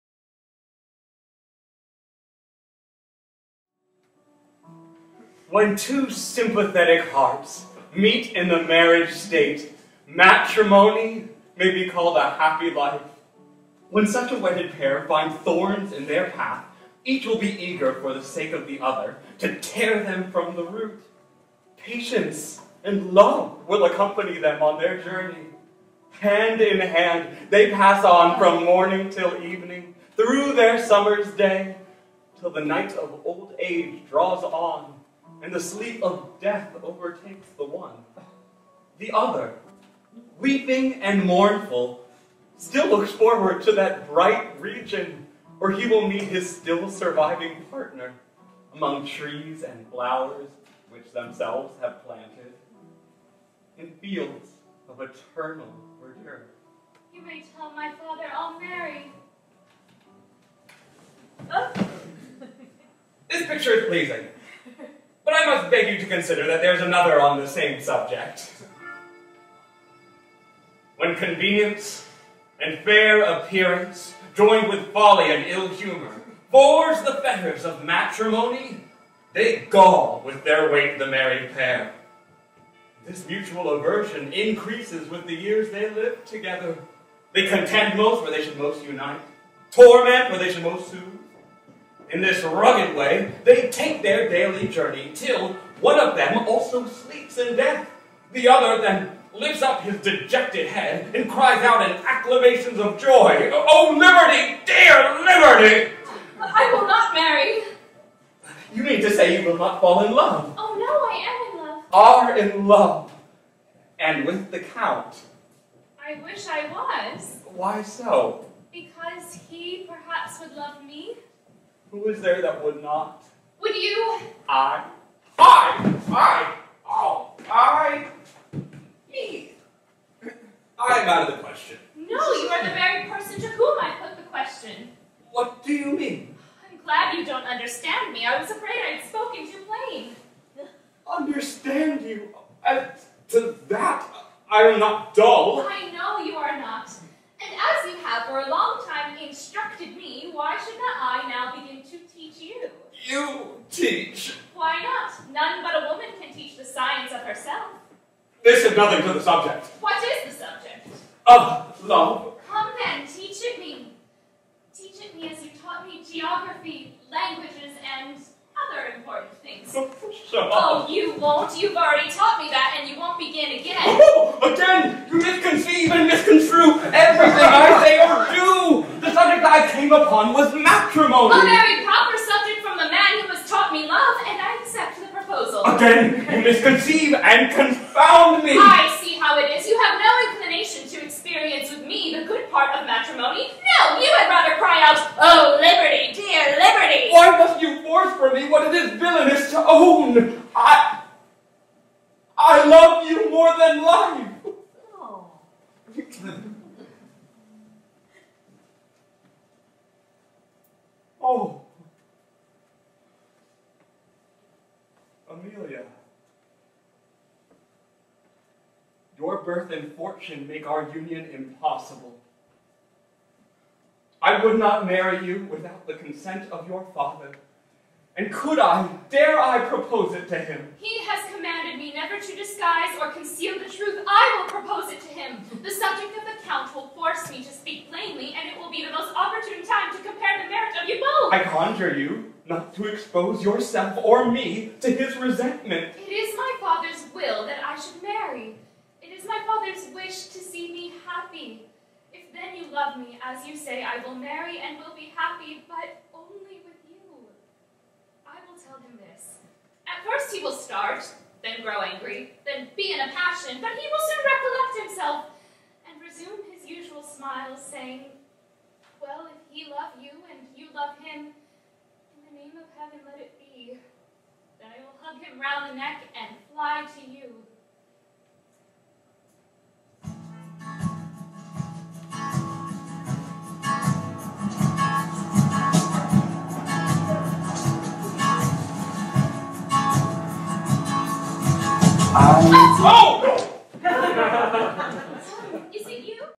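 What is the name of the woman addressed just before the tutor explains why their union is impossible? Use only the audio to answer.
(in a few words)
Amelia.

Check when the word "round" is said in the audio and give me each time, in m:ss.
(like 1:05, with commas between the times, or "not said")
4:35.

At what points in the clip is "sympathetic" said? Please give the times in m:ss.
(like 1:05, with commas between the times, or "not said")
0:06.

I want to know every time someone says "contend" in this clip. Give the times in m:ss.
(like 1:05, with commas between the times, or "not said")
1:27.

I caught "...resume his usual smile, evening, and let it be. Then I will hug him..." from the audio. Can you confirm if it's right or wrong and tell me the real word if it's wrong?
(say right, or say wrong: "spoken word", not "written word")
wrong: "saying", not "evening".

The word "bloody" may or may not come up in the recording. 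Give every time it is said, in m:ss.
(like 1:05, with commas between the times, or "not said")
not said.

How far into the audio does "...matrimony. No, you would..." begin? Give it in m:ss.
3:12.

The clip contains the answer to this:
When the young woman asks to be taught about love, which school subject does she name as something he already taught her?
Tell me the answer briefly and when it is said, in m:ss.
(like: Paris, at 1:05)
Geography, at 2:46.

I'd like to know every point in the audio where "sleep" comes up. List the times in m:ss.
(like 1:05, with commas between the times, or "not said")
0:35, 1:36.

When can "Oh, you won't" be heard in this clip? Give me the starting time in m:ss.
2:50.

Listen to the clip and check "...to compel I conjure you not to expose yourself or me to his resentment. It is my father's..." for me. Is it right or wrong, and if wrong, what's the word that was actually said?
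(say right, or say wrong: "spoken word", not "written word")
right.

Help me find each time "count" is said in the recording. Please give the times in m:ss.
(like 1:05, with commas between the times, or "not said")
1:54, 3:56.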